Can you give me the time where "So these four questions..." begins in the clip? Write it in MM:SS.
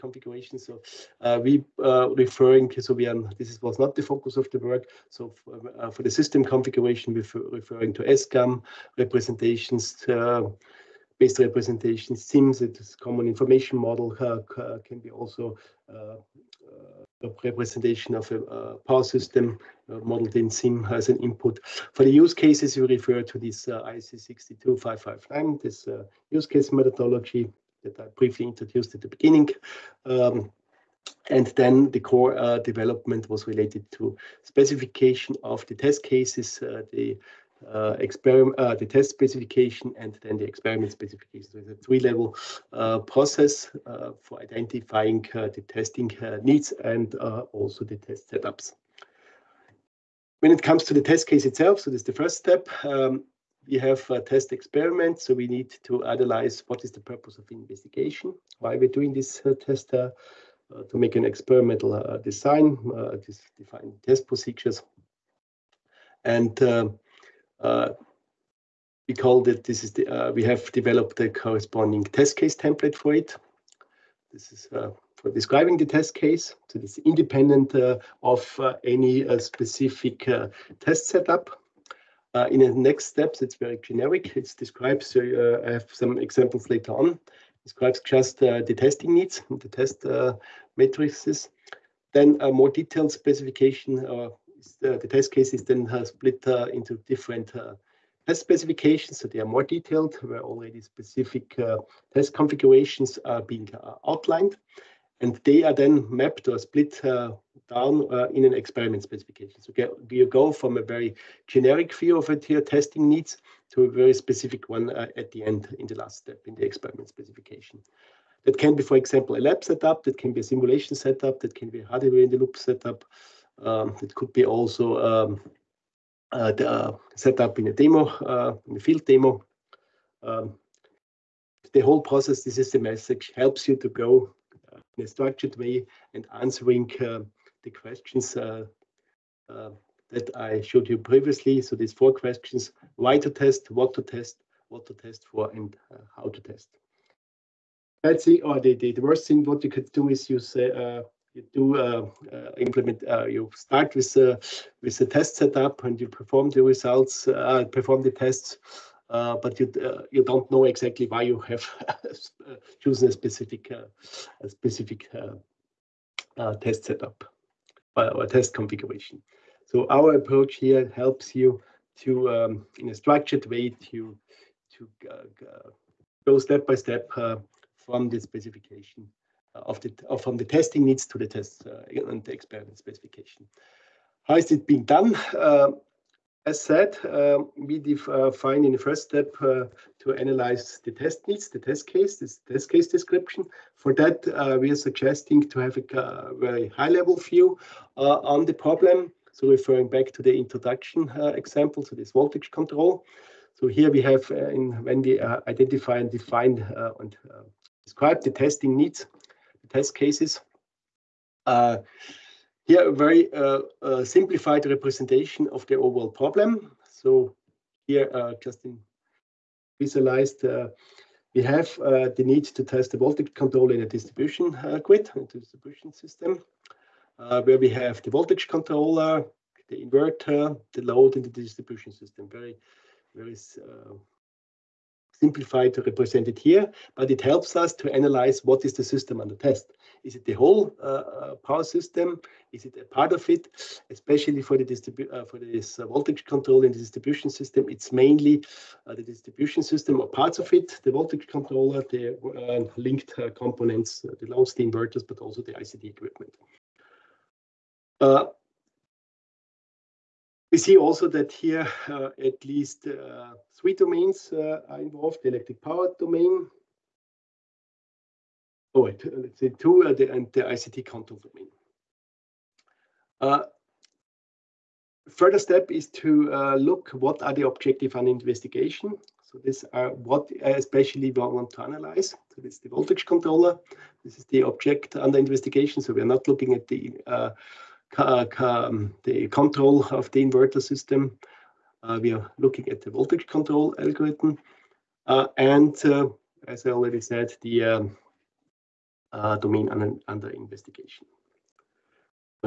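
02:21.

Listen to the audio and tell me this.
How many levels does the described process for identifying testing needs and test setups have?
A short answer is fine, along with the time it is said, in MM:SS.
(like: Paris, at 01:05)
3, at 00:41.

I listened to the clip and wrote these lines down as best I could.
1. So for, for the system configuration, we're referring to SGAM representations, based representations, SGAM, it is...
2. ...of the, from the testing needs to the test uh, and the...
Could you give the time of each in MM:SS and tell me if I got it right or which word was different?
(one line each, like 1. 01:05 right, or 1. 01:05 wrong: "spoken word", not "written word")
1. 00:05 wrong: "CIMs", not "SGAM"
2. 02:59 right.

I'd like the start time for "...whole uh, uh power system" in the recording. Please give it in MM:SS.
04:00.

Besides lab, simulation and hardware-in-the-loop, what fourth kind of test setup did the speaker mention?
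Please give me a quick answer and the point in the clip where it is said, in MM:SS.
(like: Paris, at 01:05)
field demo, at 02:08.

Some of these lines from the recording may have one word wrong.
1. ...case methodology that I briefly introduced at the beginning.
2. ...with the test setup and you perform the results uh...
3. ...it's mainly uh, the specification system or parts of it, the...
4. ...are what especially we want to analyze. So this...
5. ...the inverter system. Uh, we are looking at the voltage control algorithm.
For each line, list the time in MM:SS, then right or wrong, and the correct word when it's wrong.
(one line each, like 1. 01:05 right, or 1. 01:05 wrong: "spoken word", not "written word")
1. 00:26 right
2. 02:34 right
3. 04:07 wrong: "distribution", not "specification"
4. 04:39 right
5. 04:50 right.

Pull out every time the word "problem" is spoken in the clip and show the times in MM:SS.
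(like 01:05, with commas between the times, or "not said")
03:18, 03:36.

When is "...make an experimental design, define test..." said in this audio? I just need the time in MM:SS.
01:00.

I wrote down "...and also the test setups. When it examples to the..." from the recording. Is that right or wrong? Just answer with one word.
wrong.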